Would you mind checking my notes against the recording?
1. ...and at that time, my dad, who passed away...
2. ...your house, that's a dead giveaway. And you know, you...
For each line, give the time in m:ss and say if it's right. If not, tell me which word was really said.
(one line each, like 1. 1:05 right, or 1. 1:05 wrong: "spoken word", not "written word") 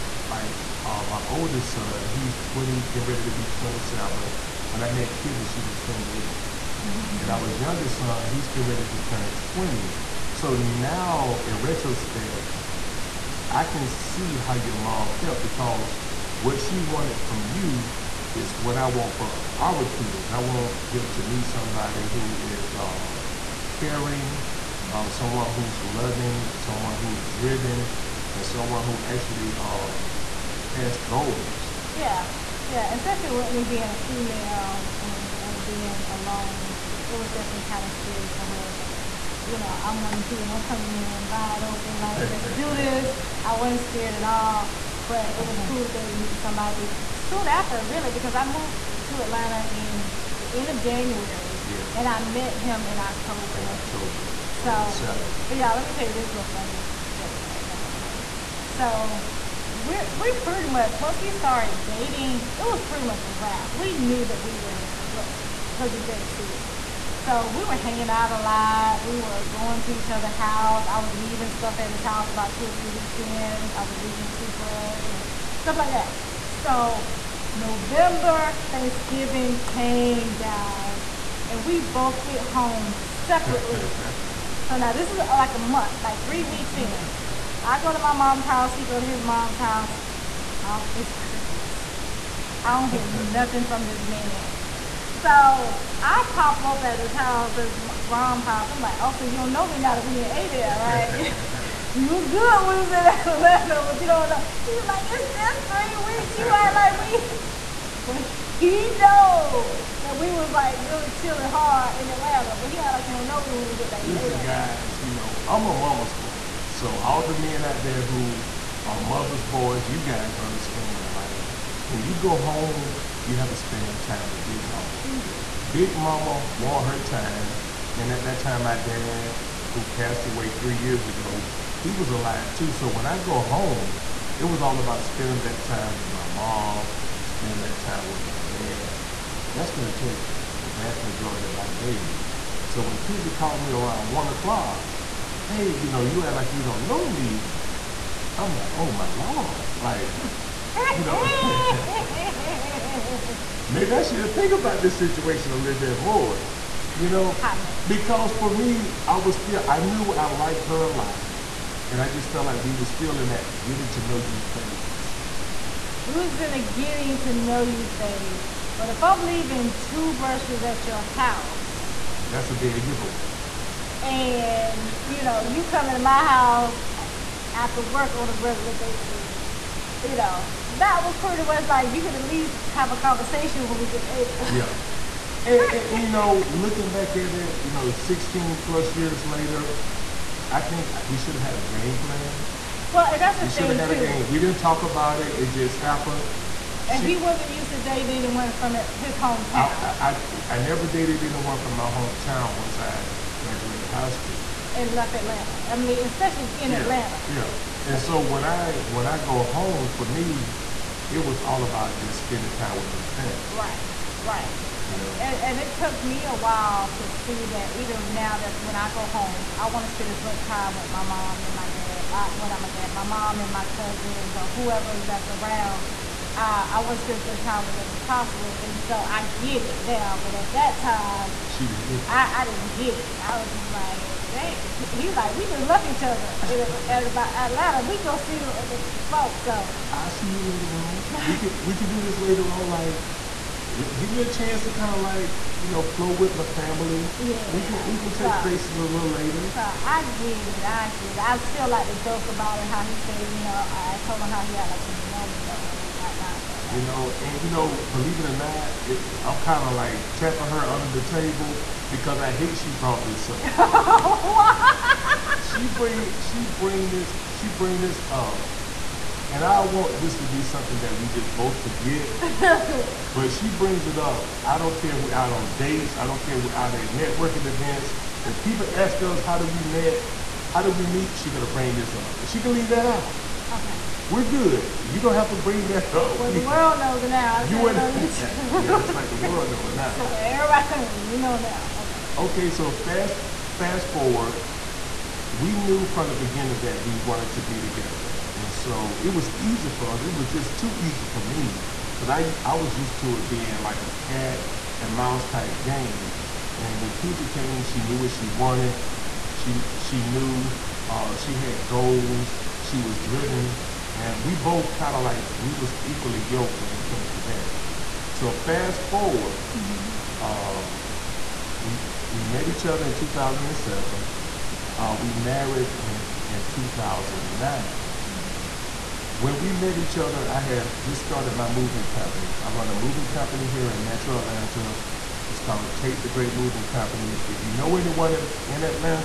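1. 2:07 right
2. 2:50 right.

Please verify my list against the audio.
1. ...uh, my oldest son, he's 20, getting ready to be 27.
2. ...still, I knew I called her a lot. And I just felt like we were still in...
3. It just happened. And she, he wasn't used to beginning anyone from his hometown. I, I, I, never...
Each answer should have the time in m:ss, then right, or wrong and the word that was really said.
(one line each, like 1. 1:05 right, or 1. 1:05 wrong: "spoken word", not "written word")
1. 0:00 right
2. 2:39 wrong: "liked", not "called"
3. 3:15 wrong: "dating", not "beginning".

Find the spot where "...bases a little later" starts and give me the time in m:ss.
4:08.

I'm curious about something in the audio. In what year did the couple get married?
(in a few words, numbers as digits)
2009.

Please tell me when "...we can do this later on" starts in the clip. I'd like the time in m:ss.
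4:01.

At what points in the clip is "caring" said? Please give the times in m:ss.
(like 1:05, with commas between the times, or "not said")
0:23.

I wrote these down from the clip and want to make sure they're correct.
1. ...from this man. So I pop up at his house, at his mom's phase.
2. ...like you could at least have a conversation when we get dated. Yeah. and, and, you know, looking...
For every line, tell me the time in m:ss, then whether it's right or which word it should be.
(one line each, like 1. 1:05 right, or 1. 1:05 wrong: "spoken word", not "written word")
1. 1:33 wrong: "house", not "phase"
2. 3:01 right.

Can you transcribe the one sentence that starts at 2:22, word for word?
So when Kizzie would call me around one o'clock, hey, you know, you act like you don't know me.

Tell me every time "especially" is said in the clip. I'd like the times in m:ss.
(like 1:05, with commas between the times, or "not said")
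0:32, 3:26.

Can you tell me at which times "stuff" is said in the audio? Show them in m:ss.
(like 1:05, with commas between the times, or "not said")
1:11, 1:15.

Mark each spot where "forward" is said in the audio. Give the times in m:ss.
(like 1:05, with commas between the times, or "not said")
4:53, 5:18.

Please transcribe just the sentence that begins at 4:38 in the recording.
If people ask us how did we met, how did we meet, she's gonna bring this up.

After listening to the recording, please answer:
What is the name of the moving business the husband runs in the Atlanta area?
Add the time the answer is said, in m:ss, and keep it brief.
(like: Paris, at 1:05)
Tate the Great Moving Company, at 5:35.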